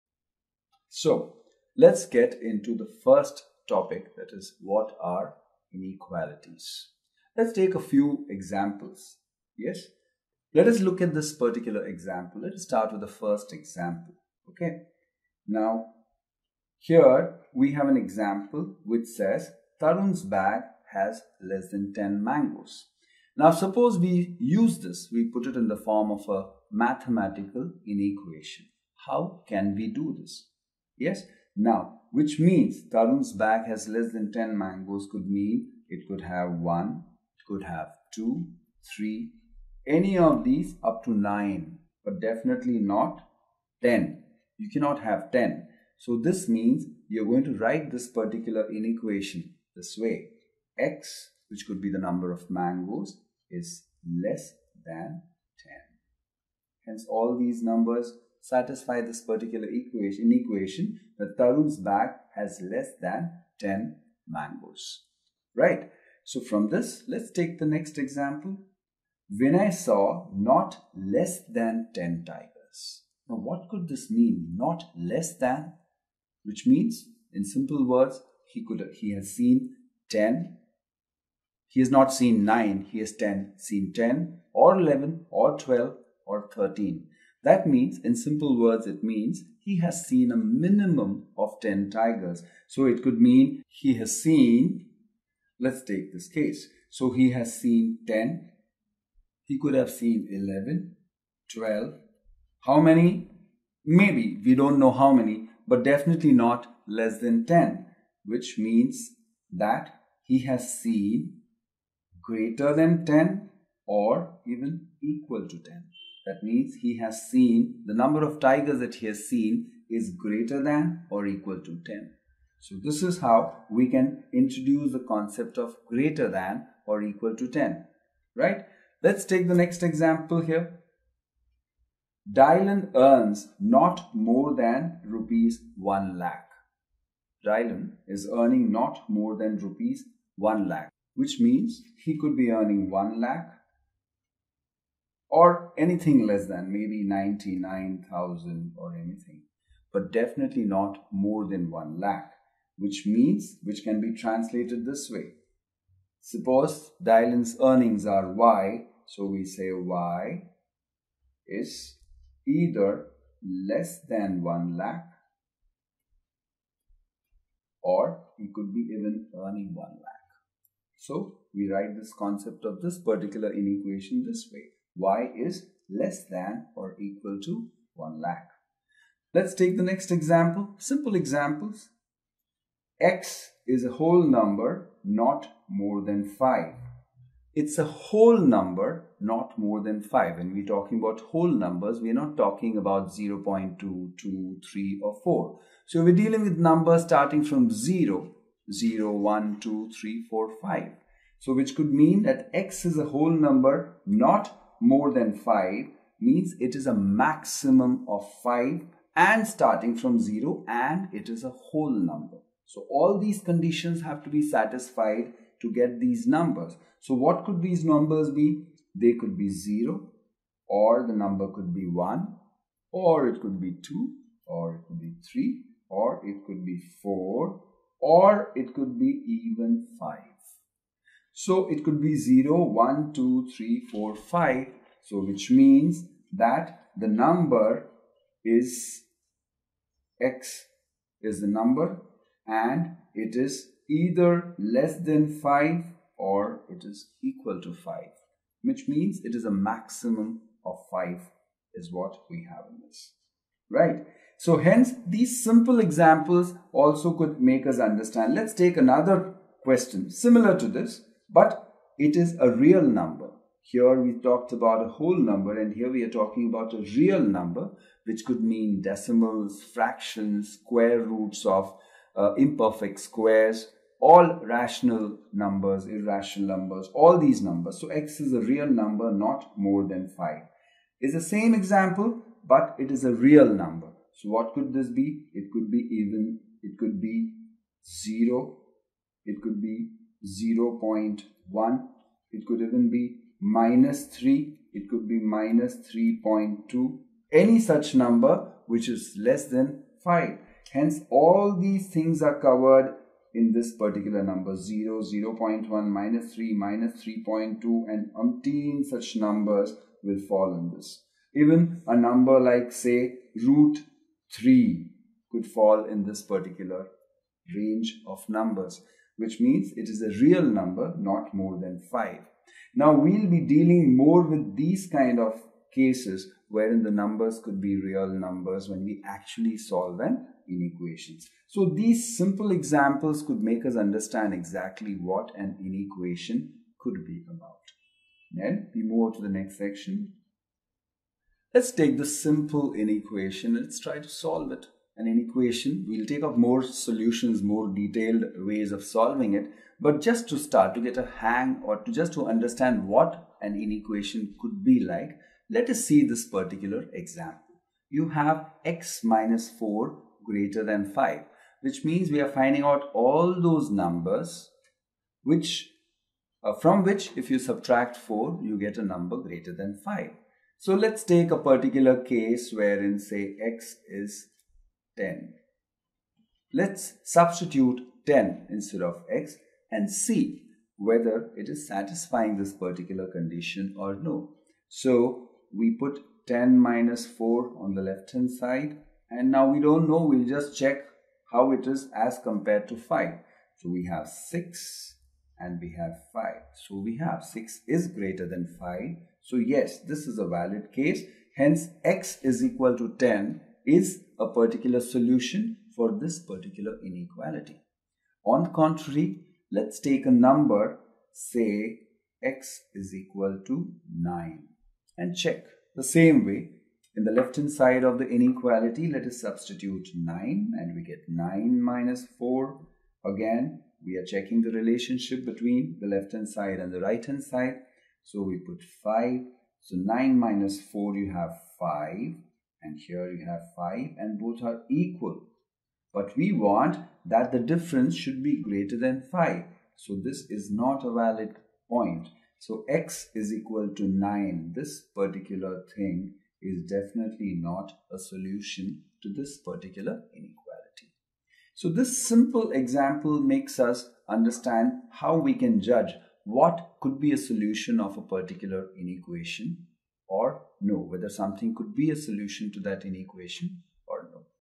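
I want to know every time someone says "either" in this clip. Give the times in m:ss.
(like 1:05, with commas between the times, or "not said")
2:42, 4:03.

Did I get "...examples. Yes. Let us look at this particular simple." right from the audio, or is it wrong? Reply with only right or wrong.
wrong.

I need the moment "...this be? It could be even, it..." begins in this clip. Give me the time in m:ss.
4:44.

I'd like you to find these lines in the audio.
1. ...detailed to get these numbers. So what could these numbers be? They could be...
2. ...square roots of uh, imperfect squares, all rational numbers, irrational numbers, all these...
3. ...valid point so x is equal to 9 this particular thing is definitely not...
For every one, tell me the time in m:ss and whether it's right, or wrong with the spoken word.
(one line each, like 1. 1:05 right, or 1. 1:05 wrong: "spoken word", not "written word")
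1. 3:34 wrong: "satisfied", not "detailed"
2. 4:30 right
3. 7:20 right.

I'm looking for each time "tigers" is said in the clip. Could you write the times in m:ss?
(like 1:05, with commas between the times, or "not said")
1:12, 1:31, 1:58.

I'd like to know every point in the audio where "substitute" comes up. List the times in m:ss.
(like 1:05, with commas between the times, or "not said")
6:17, 6:59.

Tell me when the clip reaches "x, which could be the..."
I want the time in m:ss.
0:50.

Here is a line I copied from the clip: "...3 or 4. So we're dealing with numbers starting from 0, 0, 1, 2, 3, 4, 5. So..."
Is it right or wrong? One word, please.
right.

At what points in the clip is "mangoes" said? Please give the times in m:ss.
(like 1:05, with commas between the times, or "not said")
0:22, 0:34, 0:52, 1:04.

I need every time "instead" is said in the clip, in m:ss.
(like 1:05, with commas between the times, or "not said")
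6:18.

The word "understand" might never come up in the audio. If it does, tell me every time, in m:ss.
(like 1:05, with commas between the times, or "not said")
4:17, 5:33, 5:52, 7:34.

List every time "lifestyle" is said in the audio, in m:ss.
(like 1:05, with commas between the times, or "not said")
not said.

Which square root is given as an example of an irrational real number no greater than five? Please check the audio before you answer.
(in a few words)
root 3.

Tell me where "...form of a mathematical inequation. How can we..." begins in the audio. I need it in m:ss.
0:25.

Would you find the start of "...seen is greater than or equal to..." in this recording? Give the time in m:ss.
1:59.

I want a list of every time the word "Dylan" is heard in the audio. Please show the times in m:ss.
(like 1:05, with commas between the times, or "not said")
2:12, 2:17, 2:37.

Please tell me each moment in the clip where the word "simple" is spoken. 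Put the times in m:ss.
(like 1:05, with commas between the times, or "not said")
1:17, 1:28, 3:00, 4:15, 5:32, 5:42, 7:32.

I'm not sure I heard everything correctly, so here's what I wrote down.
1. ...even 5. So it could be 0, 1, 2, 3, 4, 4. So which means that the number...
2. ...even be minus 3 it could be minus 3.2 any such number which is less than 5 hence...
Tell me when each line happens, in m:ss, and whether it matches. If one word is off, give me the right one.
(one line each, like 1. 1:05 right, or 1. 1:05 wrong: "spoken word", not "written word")
1. 3:49 wrong: "5", not "4"
2. 4:52 right.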